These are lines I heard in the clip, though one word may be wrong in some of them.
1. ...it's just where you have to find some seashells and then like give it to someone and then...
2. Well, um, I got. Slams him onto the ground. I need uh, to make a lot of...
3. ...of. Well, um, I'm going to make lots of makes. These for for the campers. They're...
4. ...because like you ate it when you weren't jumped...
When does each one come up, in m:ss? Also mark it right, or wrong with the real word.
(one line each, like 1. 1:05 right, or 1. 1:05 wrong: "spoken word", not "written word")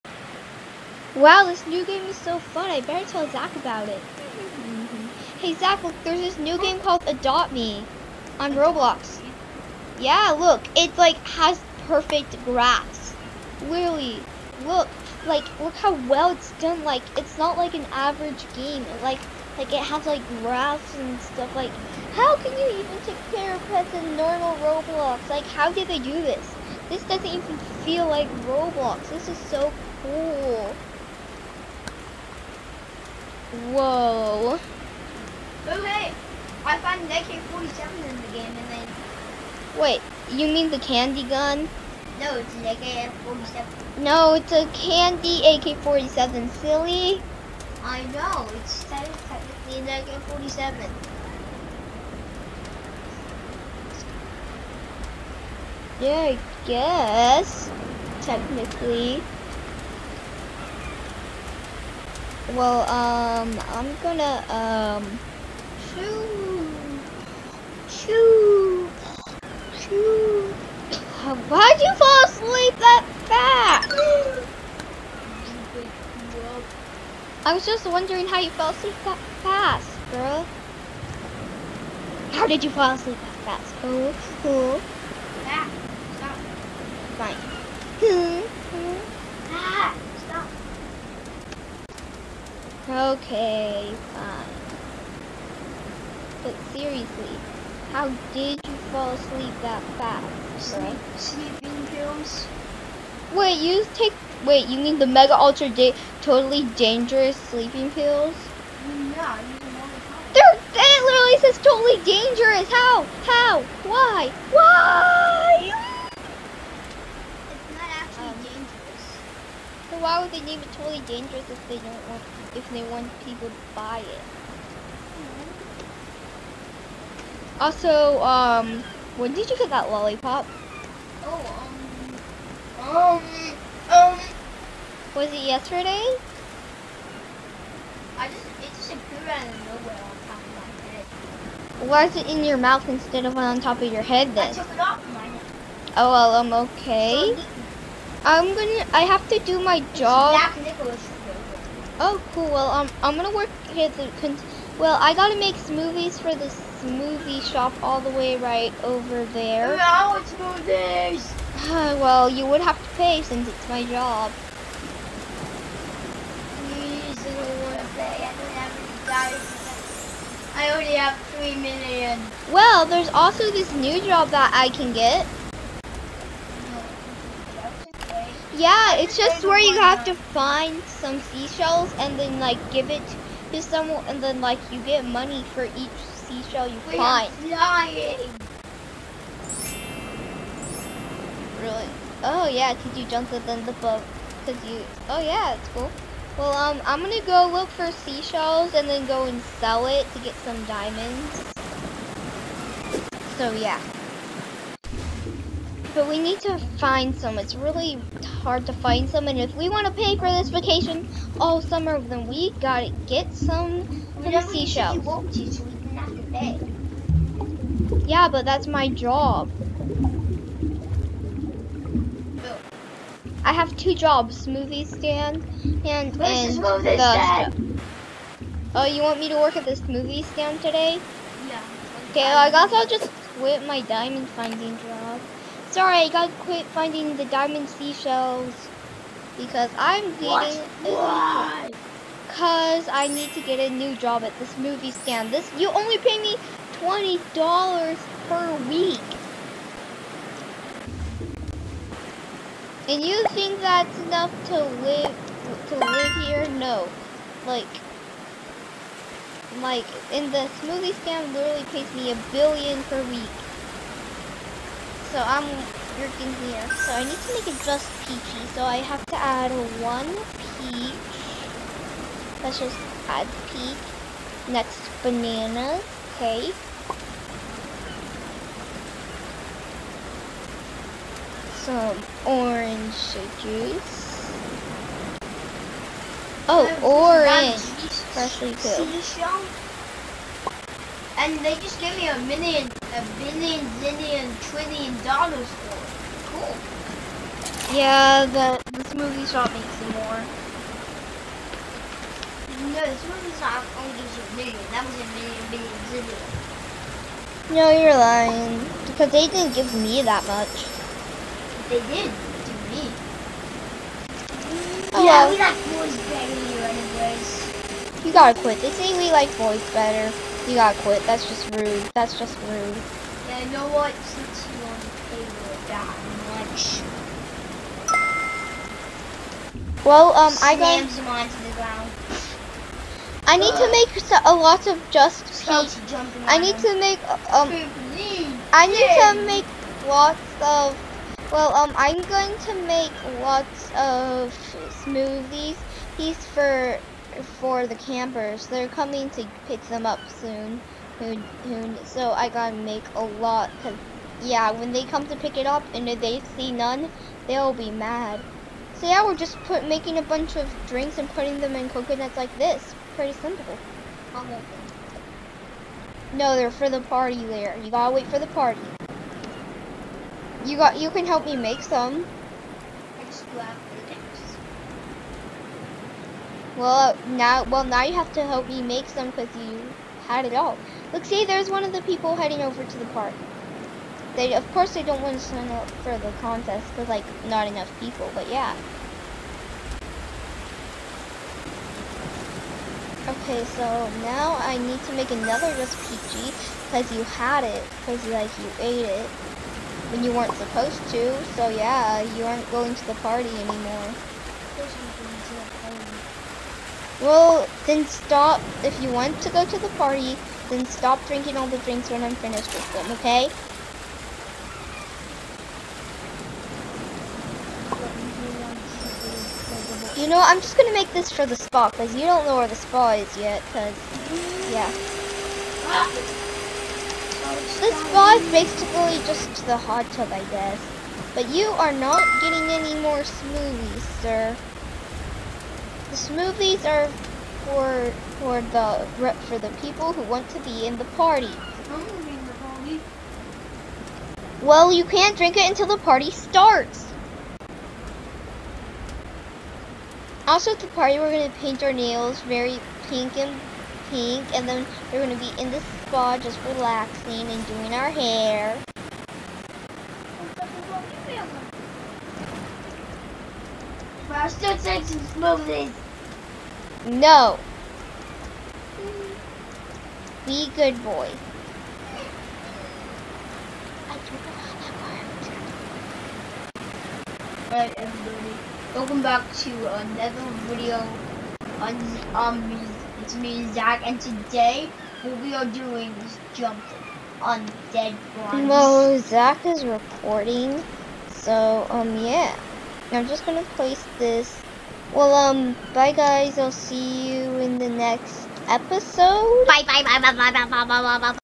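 1. 2:58 right
2. 5:29 right
3. 5:40 wrong: "smoothies", not "makes"
4. 6:37 wrong: "supposed", not "jumped".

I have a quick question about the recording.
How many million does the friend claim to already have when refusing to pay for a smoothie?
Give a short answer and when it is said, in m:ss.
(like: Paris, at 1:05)
3 million, at 2:51.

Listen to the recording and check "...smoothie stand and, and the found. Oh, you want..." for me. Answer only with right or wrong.
wrong.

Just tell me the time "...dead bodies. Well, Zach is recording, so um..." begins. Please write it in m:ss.
8:07.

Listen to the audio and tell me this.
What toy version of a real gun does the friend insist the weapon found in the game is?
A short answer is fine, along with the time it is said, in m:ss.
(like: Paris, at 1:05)
Candy AK-47, at 0:44.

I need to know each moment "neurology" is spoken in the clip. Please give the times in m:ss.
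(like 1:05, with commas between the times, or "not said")
not said.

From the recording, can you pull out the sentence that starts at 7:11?
But you are not getting any more smoothies, sir.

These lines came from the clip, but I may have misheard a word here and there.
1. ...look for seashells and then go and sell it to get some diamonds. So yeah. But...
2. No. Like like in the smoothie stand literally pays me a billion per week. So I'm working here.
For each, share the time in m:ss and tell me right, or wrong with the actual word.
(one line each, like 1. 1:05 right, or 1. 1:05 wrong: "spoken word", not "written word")
1. 3:17 right
2. 4:16 right.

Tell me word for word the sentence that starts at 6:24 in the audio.
They, of course, they don't want to sign up for the contest because, like, not enough people.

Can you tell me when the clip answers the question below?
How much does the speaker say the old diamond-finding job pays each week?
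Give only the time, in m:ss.
4:06.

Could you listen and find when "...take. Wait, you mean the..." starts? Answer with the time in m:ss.
1:43.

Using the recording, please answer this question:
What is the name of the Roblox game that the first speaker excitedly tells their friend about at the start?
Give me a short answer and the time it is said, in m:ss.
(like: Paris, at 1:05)
Adopt Me, at 0:07.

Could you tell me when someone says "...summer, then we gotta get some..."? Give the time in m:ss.
3:31.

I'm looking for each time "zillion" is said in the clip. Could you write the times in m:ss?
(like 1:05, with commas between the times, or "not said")
4:53, 5:05.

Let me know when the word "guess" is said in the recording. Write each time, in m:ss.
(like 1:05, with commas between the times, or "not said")
0:56, 3:52, 7:10.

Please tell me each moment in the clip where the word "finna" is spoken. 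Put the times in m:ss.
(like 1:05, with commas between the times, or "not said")
not said.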